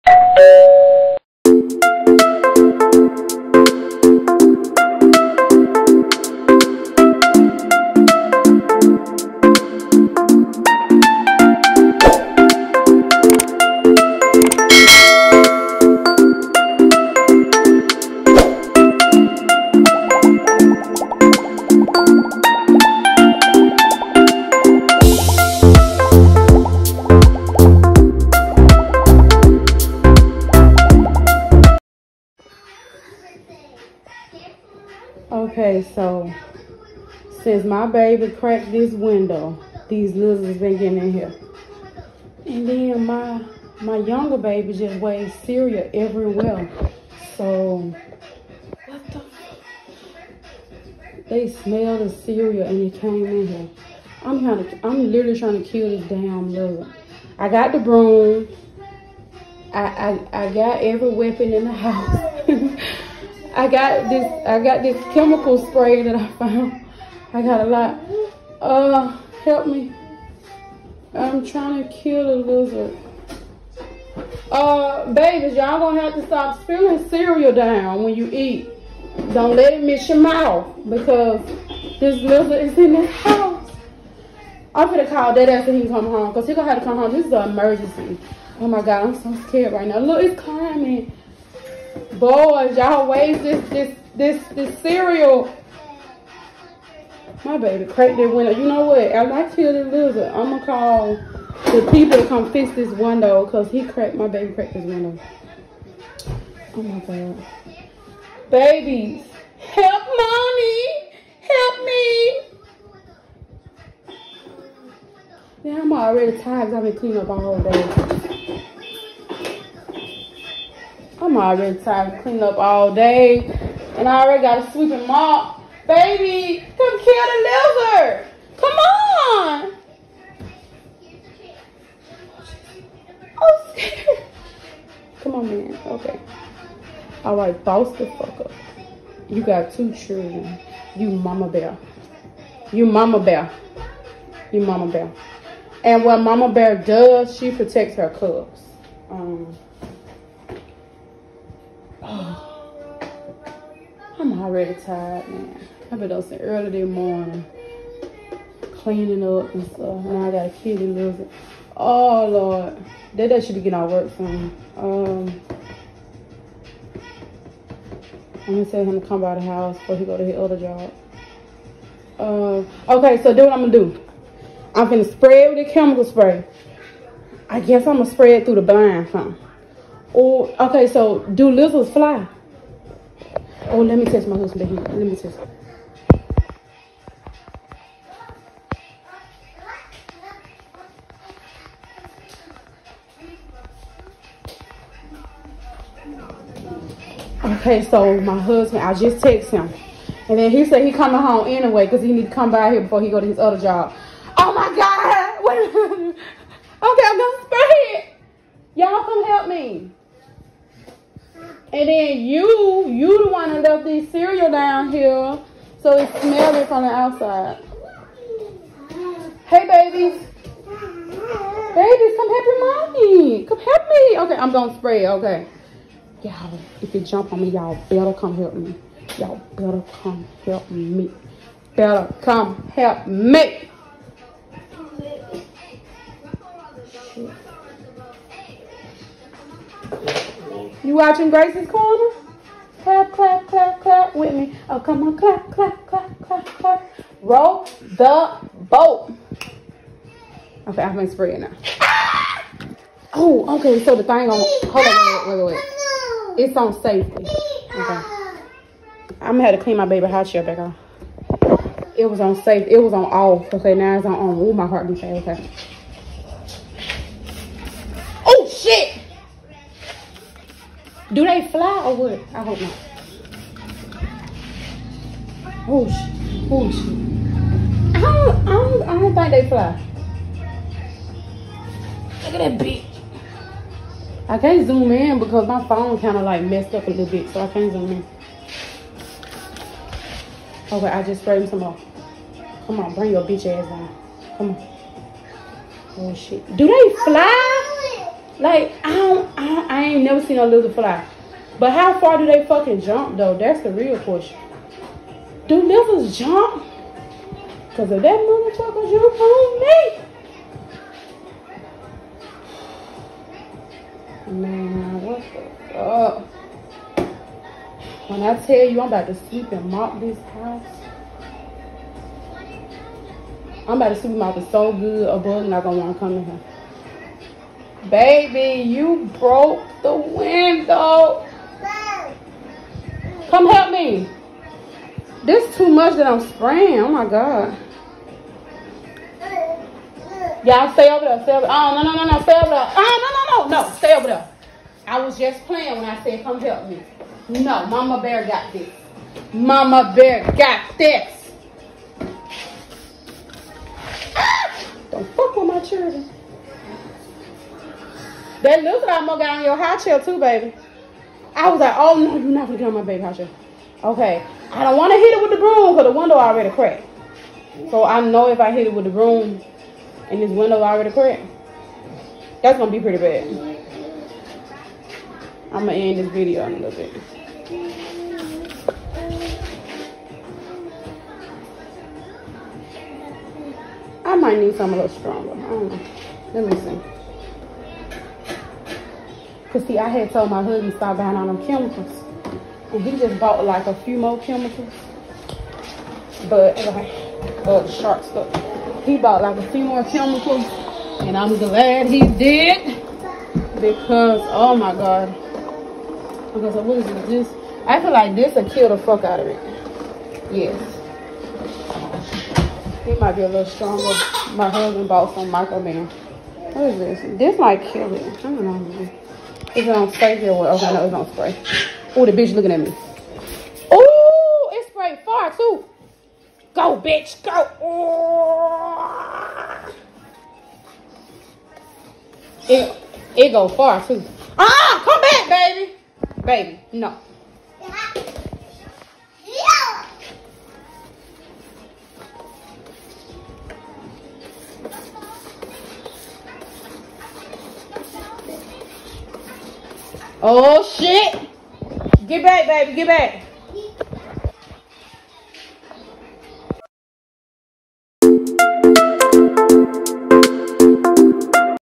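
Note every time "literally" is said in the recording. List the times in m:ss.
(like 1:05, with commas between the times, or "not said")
0:55.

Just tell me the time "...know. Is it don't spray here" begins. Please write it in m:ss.
6:58.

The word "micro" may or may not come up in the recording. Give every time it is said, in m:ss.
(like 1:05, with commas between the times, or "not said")
6:55.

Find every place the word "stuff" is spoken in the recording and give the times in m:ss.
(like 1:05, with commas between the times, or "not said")
2:39, 6:38.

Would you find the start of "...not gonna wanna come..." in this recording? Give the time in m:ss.
5:25.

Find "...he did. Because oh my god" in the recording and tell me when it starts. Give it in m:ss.
6:41.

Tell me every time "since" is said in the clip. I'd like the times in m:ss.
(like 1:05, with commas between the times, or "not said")
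0:37, 2:36.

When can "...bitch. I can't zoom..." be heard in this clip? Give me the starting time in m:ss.
4:42.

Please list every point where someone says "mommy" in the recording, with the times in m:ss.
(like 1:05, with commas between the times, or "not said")
1:50, 3:42.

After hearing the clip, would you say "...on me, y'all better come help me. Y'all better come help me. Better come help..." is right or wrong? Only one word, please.
right.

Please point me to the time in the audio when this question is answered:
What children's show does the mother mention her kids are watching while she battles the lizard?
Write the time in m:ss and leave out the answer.
4:01.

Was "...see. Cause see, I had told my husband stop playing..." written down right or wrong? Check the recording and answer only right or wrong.
wrong.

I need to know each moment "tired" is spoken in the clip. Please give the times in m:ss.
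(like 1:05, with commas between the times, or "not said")
1:56, 2:01, 2:34.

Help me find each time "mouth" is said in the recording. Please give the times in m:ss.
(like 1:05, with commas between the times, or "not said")
1:20.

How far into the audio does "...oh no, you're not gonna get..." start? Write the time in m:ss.
6:01.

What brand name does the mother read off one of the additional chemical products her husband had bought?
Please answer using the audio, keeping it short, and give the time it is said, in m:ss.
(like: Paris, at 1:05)
Shark, at 6:37.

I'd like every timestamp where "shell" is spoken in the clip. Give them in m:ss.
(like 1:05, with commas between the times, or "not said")
4:20.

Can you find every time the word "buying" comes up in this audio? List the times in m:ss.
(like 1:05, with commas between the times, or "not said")
6:30.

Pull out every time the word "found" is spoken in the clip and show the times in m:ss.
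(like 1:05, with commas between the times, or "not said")
1:06.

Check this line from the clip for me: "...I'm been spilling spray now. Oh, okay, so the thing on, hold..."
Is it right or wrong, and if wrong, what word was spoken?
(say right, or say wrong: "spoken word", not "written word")
wrong: "spraying", not "spilling".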